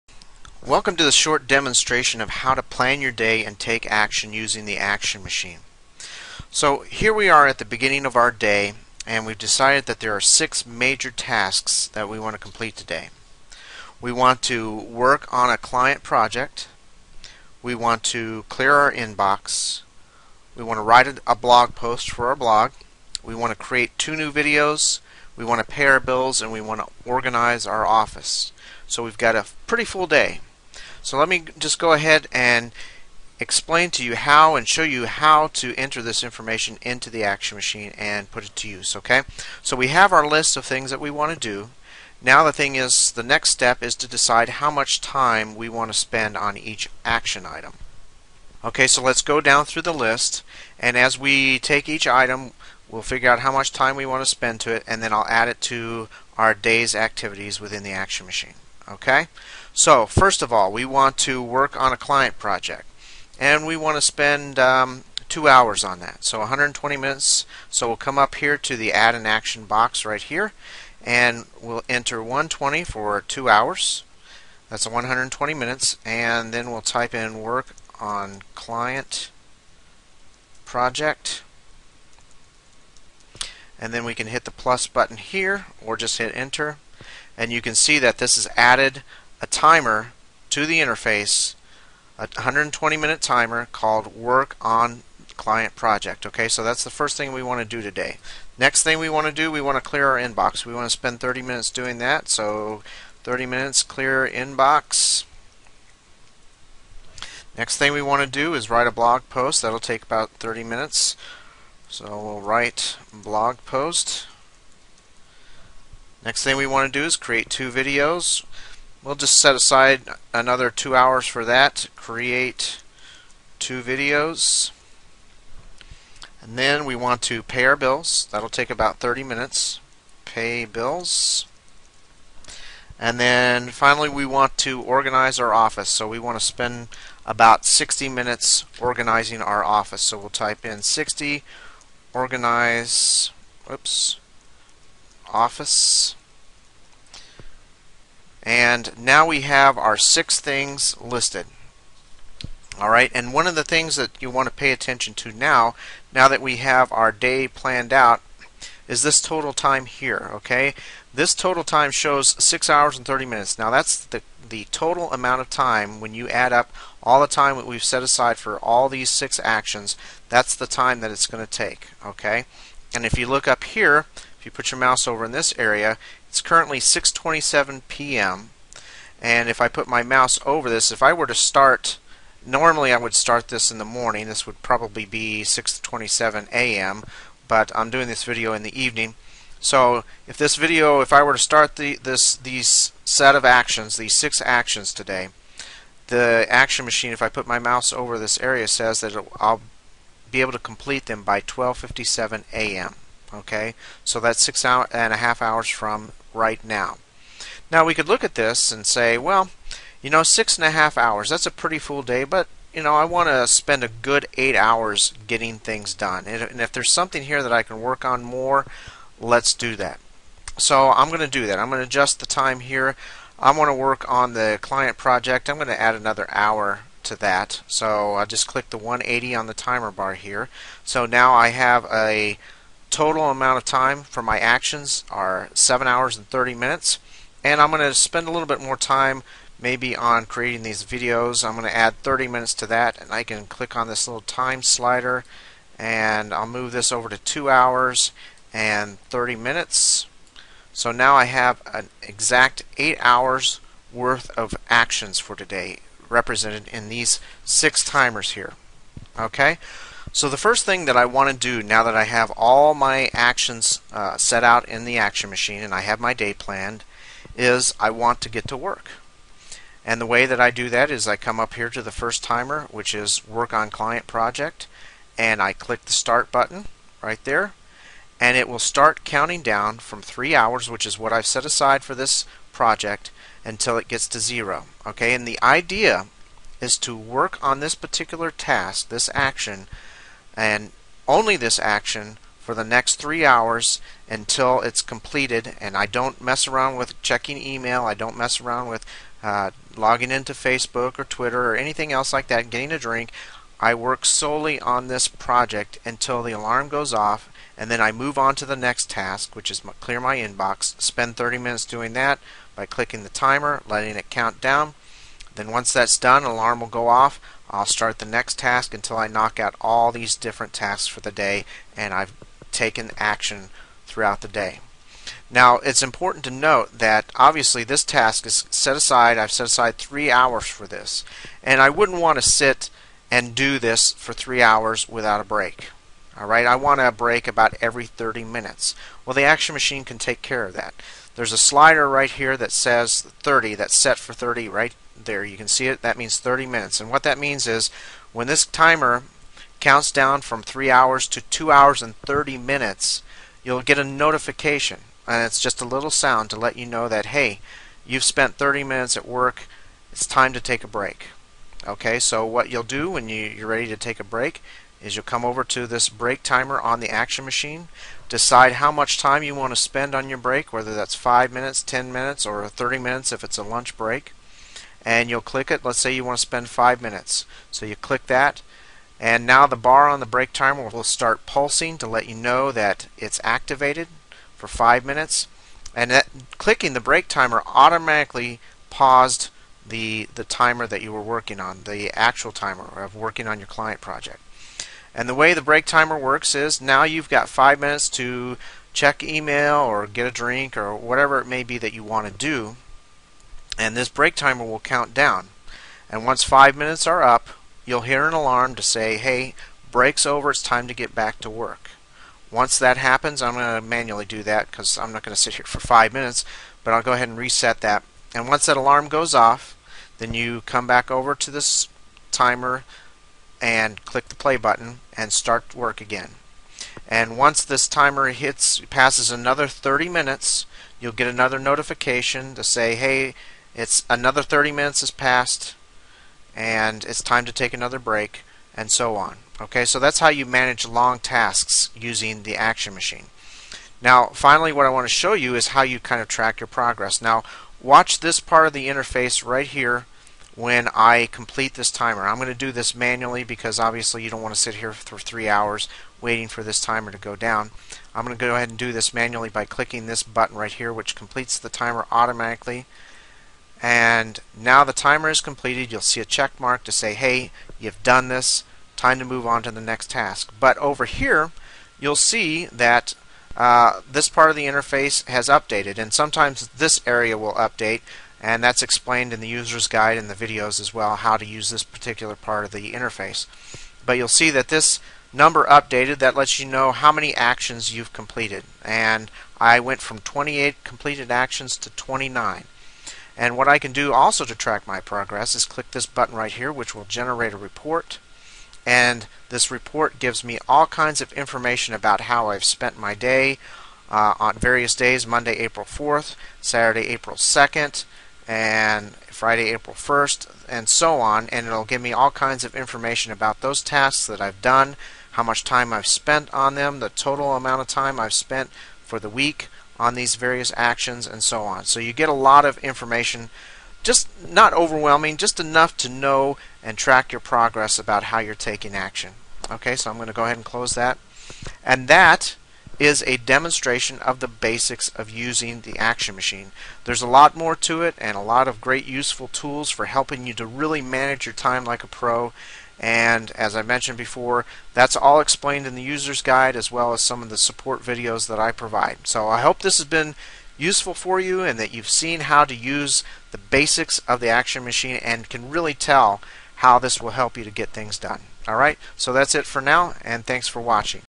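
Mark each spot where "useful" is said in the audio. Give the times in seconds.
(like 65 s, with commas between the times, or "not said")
538 s, 550 s.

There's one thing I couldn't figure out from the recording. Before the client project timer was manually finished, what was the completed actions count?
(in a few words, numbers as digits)
28.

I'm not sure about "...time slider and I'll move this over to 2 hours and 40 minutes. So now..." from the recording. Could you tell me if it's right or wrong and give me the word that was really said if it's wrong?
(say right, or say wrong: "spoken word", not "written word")
wrong: "30", not "40".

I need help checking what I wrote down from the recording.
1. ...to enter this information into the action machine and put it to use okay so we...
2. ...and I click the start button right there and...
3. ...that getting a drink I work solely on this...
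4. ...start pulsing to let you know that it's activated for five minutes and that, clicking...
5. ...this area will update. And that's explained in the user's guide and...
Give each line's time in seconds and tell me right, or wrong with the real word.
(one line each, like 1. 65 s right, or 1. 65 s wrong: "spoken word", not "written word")
1. 35 s right
2. 275 s right
3. 302 s right
4. 380 s right
5. 476 s right.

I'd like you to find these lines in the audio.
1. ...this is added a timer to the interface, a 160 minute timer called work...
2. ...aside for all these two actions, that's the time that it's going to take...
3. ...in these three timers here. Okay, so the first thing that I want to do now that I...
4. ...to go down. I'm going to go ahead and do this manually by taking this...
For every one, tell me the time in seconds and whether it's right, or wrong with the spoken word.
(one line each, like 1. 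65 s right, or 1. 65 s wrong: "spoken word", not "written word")
1. 88 s wrong: "120", not "160"
2. 168 s wrong: "six", not "two"
3. 256 s wrong: "six", not "three"
4. 456 s wrong: "clicking", not "taking".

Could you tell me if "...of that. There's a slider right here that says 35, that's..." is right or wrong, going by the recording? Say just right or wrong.
wrong.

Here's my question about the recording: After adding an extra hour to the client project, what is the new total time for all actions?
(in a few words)
7 hours and 30 minutes.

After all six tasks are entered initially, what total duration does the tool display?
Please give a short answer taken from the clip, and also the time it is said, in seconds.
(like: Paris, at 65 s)
6 hours and 30 minutes, at 162 s.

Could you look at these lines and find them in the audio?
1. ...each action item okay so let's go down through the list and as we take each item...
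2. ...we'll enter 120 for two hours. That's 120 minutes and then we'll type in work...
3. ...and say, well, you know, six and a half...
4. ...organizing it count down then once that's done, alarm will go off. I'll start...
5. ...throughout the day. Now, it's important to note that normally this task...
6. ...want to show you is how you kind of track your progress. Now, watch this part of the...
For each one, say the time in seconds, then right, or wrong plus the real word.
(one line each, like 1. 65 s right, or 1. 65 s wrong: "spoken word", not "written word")
1. 46 s right
2. 71 s right
3. 208 s right
4. 313 s wrong: "letting", not "organizing"
5. 323 s wrong: "obviously", not "normally"
6. 444 s right.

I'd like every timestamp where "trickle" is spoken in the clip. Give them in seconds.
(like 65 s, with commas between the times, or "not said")
not said.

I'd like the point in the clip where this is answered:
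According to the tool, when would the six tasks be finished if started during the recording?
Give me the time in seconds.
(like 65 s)
201 s.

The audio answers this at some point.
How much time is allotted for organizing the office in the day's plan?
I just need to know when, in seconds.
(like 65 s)
137 s.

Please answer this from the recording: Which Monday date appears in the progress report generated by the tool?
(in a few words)
April 4th.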